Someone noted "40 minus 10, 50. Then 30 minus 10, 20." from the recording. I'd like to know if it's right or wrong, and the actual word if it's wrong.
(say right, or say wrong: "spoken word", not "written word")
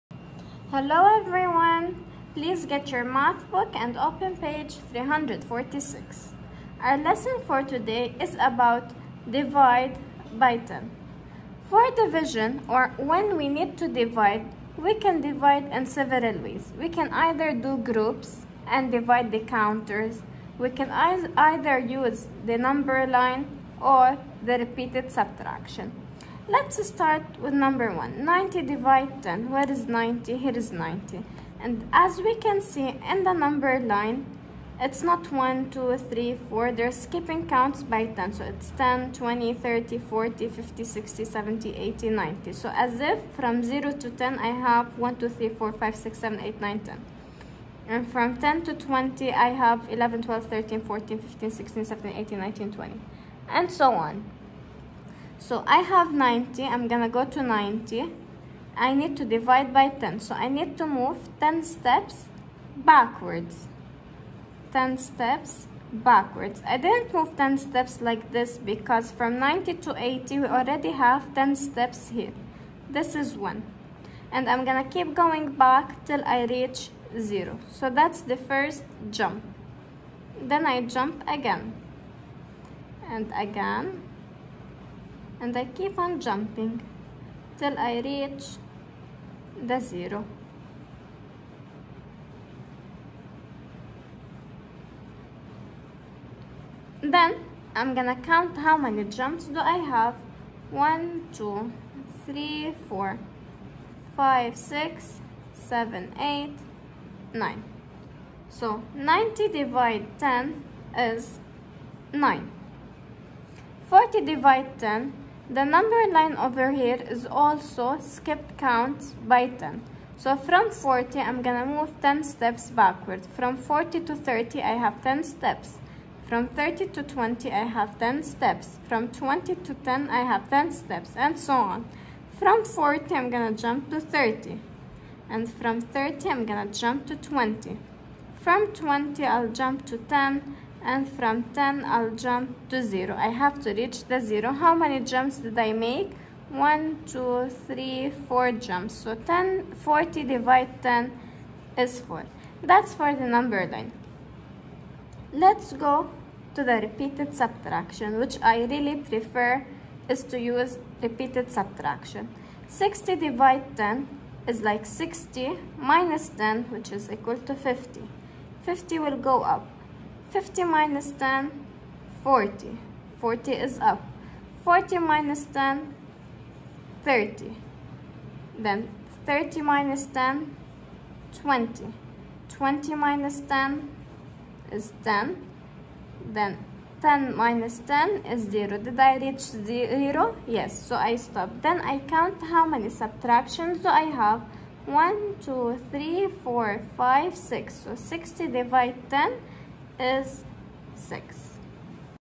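wrong: "30", not "50".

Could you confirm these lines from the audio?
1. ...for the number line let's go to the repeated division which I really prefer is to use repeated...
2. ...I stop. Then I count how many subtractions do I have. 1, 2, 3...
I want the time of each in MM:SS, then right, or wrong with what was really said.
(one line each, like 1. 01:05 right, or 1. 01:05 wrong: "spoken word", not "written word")
1. 02:32 wrong: "subtraction", not "division"
2. 03:10 right.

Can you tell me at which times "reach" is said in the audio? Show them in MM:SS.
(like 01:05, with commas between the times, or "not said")
01:16, 01:28, 02:23, 03:09.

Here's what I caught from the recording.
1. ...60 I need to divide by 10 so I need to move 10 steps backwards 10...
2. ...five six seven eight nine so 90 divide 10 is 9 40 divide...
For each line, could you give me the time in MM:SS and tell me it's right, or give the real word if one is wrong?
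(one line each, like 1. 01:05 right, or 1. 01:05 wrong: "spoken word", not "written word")
1. 00:57 wrong: "90", not "60"
2. 01:44 right.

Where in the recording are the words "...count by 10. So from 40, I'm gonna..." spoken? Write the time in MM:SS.
01:58.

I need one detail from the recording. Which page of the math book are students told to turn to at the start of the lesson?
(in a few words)
346.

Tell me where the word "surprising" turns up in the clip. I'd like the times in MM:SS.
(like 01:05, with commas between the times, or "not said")
not said.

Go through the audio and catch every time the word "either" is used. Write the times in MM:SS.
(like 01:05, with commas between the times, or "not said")
00:17, 00:21.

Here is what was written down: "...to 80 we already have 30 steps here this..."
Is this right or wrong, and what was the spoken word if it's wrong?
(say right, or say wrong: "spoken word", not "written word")
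wrong: "10", not "30".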